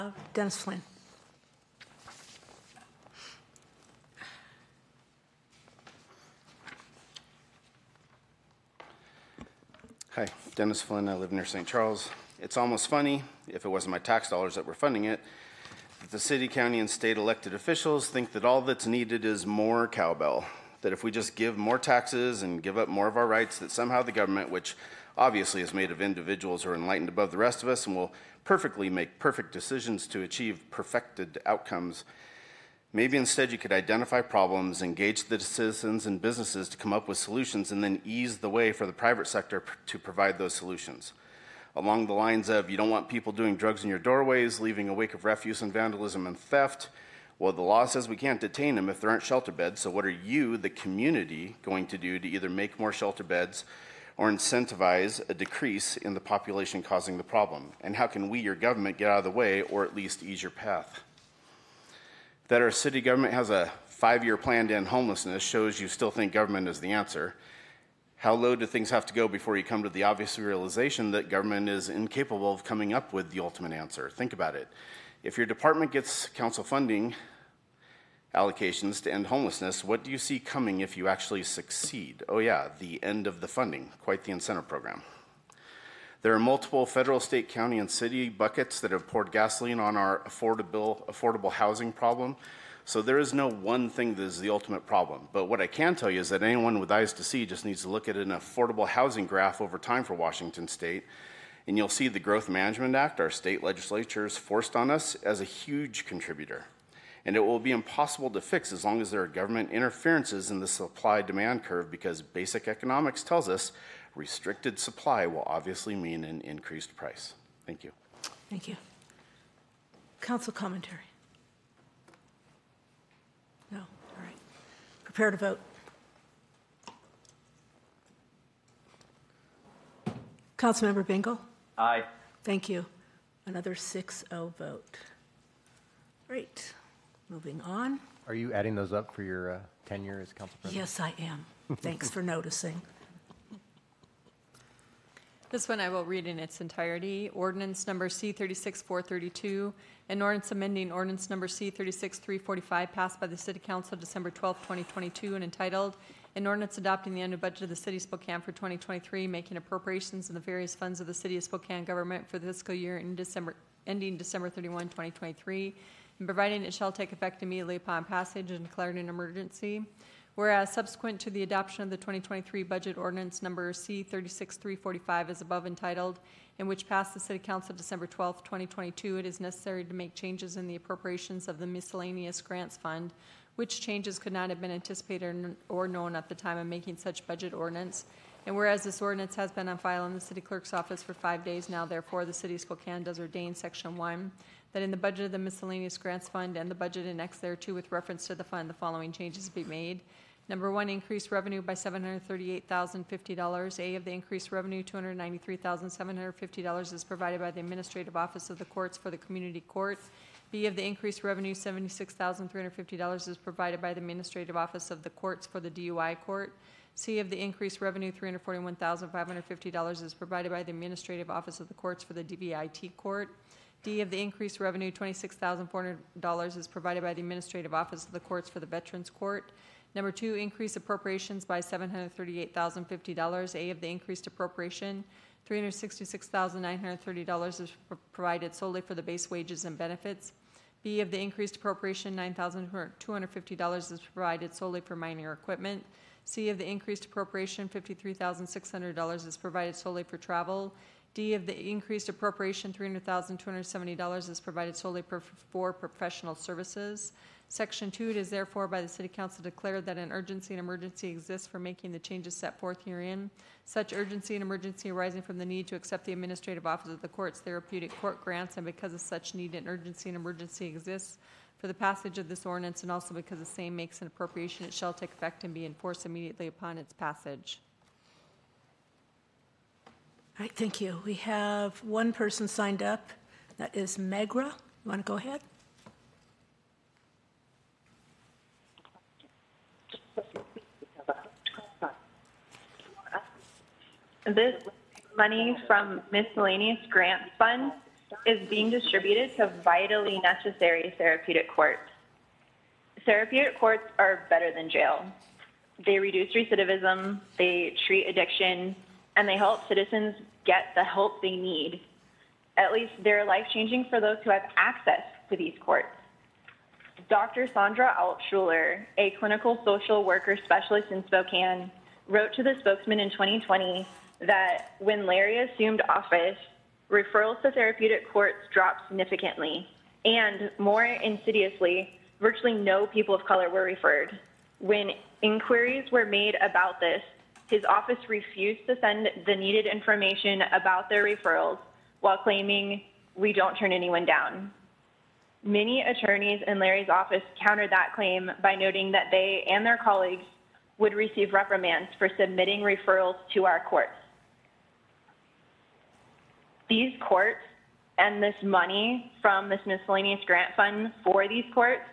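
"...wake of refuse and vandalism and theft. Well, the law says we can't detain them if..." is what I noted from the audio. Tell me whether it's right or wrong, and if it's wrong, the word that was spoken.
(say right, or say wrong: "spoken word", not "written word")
right.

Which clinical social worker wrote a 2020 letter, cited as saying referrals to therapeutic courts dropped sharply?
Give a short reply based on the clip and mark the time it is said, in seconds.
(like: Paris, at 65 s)
Sandra Altschuler, at 317 s.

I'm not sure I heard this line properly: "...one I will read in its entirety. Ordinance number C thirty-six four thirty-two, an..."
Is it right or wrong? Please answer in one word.
right.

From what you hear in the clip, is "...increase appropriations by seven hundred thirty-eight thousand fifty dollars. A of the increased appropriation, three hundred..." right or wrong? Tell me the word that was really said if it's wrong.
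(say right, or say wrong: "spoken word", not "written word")
right.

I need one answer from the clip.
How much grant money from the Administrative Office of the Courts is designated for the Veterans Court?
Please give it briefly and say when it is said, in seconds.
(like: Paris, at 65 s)
$26,400, at 224 s.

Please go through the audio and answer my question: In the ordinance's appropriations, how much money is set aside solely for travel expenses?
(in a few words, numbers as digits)
$53,600.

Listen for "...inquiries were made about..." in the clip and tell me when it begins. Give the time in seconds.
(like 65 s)
335 s.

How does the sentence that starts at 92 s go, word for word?
So there is no one thing that is the ultimate problem.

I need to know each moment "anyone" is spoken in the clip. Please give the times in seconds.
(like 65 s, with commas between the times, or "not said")
96 s, 343 s.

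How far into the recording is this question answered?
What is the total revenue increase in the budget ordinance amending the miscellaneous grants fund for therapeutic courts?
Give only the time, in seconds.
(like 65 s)
201 s.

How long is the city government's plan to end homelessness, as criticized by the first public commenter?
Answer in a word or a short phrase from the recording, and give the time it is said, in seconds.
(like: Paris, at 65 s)
5 years, at 63 s.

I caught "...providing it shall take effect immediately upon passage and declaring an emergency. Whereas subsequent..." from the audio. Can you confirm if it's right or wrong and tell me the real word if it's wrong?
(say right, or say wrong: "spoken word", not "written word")
right.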